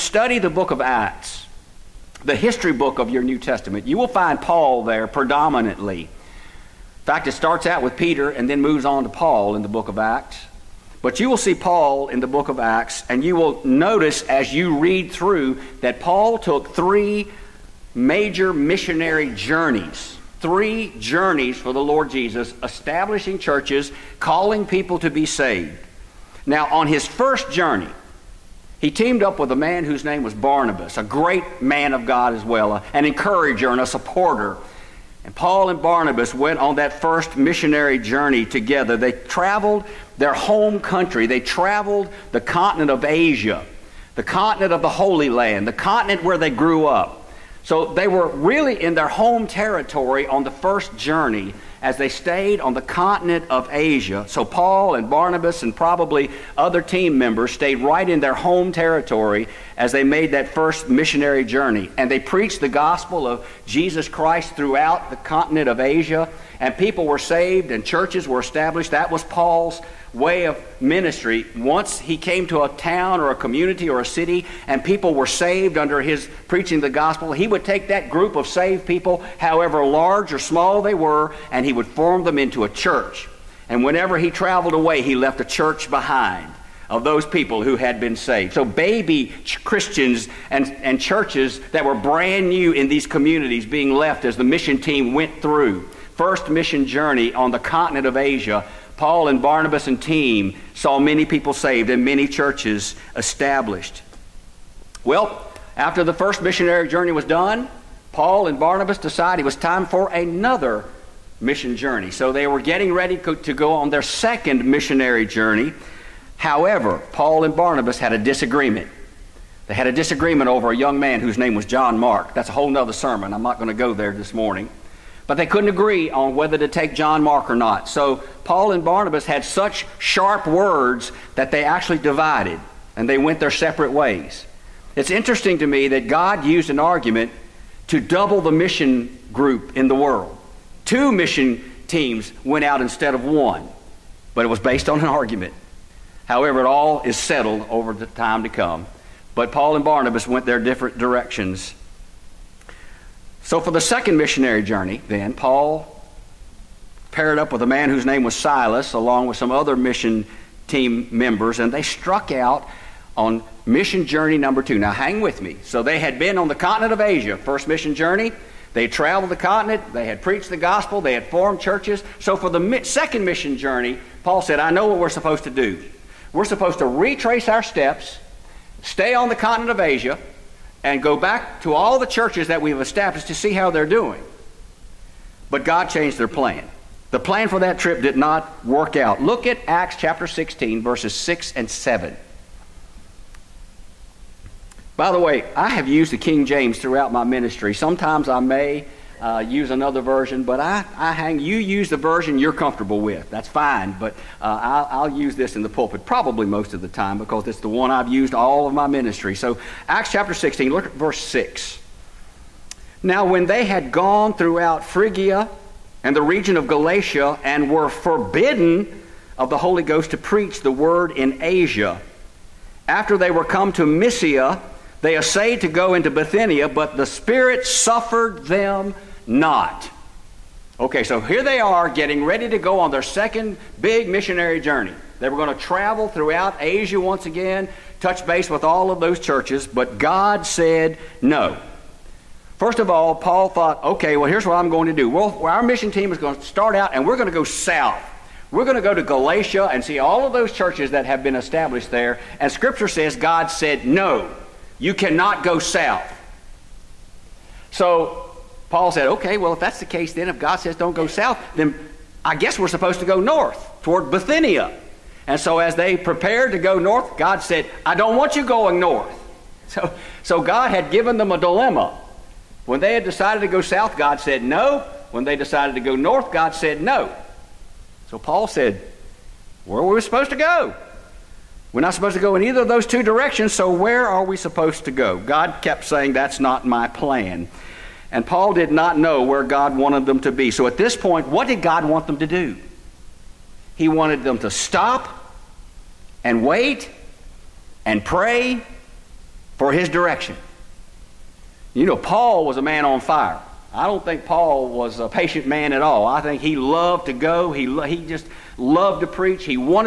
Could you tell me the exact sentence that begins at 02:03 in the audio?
I'm not going to go there this morning.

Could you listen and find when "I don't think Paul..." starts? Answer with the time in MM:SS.
05:03.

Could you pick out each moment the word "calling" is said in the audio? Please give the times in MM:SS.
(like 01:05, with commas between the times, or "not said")
00:24.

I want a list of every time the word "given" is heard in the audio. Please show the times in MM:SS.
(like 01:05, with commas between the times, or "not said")
04:30.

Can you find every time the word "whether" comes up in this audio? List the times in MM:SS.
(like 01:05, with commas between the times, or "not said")
02:06.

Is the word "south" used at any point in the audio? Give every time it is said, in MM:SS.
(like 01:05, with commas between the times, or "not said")
04:07, 04:15, 04:21, 04:33.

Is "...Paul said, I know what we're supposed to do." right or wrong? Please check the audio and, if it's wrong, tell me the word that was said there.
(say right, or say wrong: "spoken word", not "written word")
right.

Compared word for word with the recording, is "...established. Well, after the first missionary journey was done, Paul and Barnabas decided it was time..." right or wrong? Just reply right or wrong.
right.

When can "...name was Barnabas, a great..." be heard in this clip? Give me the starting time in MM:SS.
00:30.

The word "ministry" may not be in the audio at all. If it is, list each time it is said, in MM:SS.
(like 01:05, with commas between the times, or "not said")
01:10, 03:17, 03:28.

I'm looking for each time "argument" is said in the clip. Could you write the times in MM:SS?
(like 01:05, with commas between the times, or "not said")
02:16, 02:25.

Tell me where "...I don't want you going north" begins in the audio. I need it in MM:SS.
04:27.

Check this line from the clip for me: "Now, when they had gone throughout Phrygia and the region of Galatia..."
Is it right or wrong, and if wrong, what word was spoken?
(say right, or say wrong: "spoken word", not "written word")
right.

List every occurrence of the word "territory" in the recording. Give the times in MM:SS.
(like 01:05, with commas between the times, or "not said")
00:49, 00:58.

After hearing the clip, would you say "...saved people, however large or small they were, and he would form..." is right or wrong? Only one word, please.
right.